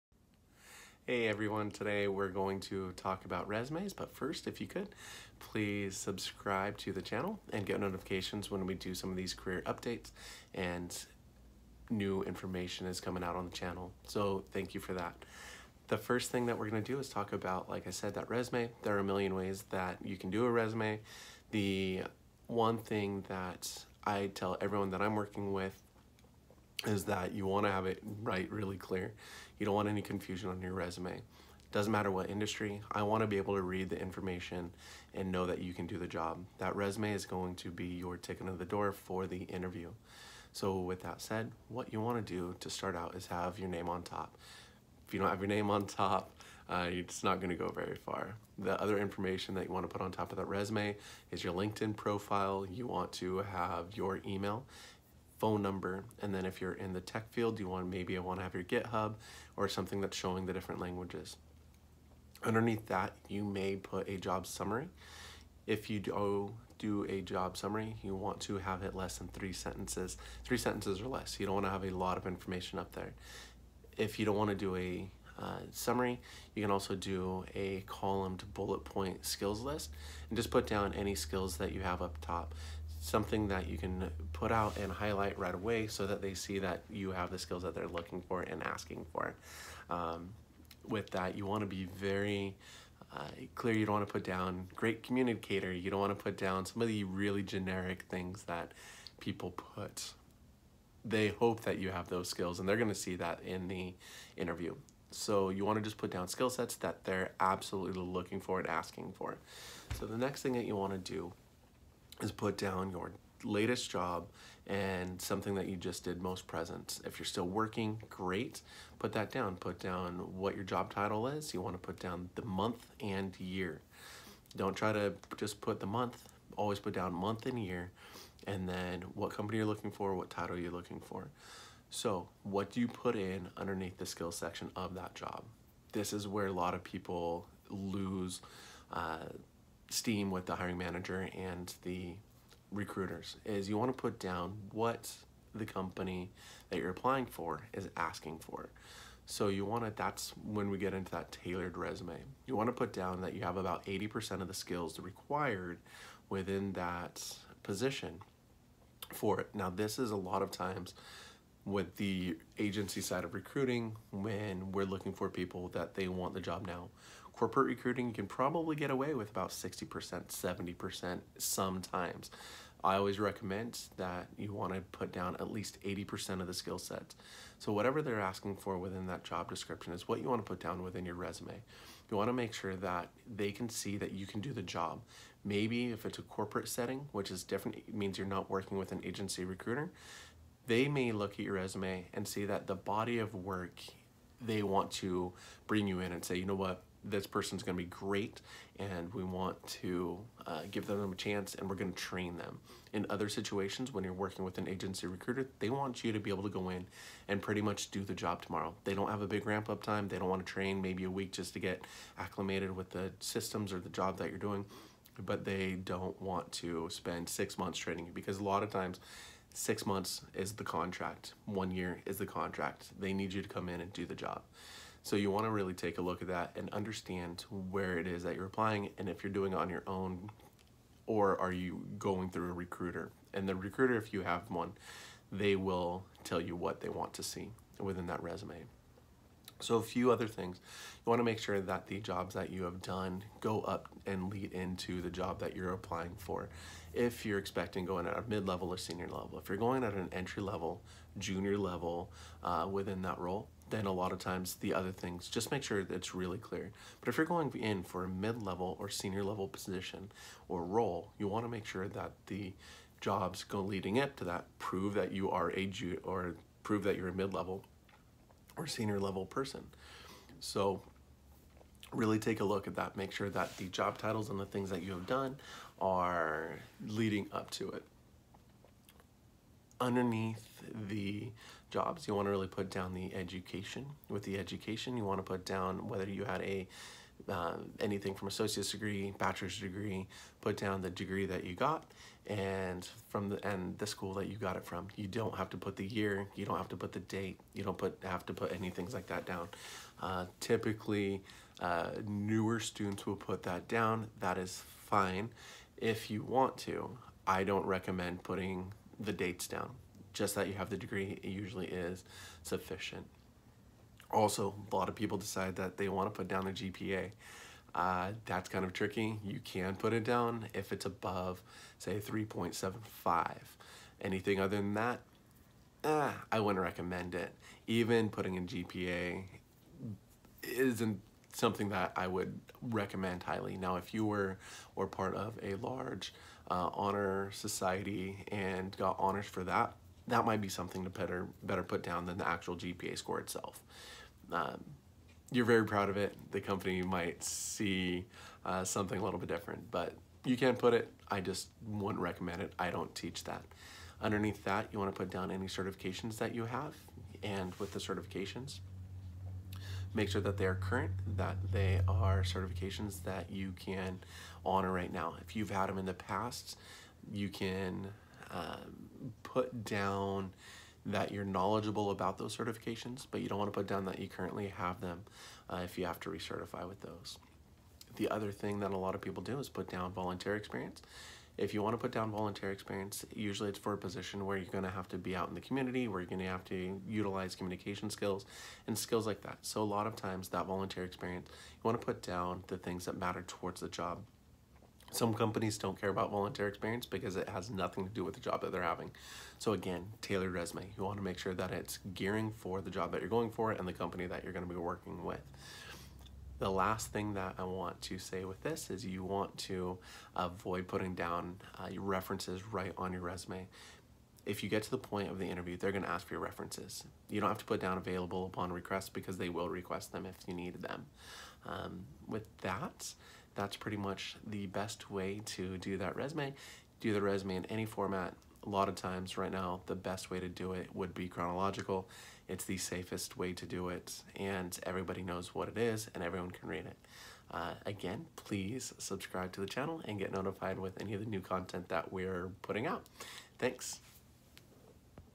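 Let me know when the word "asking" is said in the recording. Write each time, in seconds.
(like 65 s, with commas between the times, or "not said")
88 s, 108 s, 147 s, 178 s.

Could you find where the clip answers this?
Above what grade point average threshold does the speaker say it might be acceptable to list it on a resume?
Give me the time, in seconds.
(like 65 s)
321 s.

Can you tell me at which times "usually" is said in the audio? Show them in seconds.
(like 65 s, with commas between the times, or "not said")
311 s, 383 s.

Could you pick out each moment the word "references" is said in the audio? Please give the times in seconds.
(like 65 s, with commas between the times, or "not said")
411 s, 416 s.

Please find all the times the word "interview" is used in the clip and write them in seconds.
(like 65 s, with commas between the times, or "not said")
39 s, 104 s, 415 s.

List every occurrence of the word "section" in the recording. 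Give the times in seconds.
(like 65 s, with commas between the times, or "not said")
134 s.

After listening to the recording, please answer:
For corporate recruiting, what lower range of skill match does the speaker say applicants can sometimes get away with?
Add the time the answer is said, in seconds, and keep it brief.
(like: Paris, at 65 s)
60% to 70%, at 169 s.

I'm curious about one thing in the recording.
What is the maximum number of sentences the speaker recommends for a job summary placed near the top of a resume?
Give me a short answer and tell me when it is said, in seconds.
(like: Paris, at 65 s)
3, at 70 s.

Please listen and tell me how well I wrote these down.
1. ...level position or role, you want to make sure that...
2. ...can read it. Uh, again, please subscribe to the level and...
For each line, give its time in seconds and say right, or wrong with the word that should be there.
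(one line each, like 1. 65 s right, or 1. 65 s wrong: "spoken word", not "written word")
1. 259 s right
2. 436 s wrong: "channel", not "level".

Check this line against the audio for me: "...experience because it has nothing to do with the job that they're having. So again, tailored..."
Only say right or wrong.
right.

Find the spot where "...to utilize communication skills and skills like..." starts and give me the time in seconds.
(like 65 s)
386 s.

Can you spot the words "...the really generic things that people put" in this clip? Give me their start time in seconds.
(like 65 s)
96 s.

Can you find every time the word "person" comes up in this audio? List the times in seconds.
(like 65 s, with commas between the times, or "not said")
197 s, 269 s.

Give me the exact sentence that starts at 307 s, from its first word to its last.
I don't recommend putting the dates down.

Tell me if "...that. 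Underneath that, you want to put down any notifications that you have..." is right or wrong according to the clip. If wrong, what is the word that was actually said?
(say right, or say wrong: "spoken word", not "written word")
wrong: "certifications", not "notifications".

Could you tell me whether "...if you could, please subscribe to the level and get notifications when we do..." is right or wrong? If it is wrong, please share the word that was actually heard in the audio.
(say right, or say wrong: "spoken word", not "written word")
wrong: "channel", not "level".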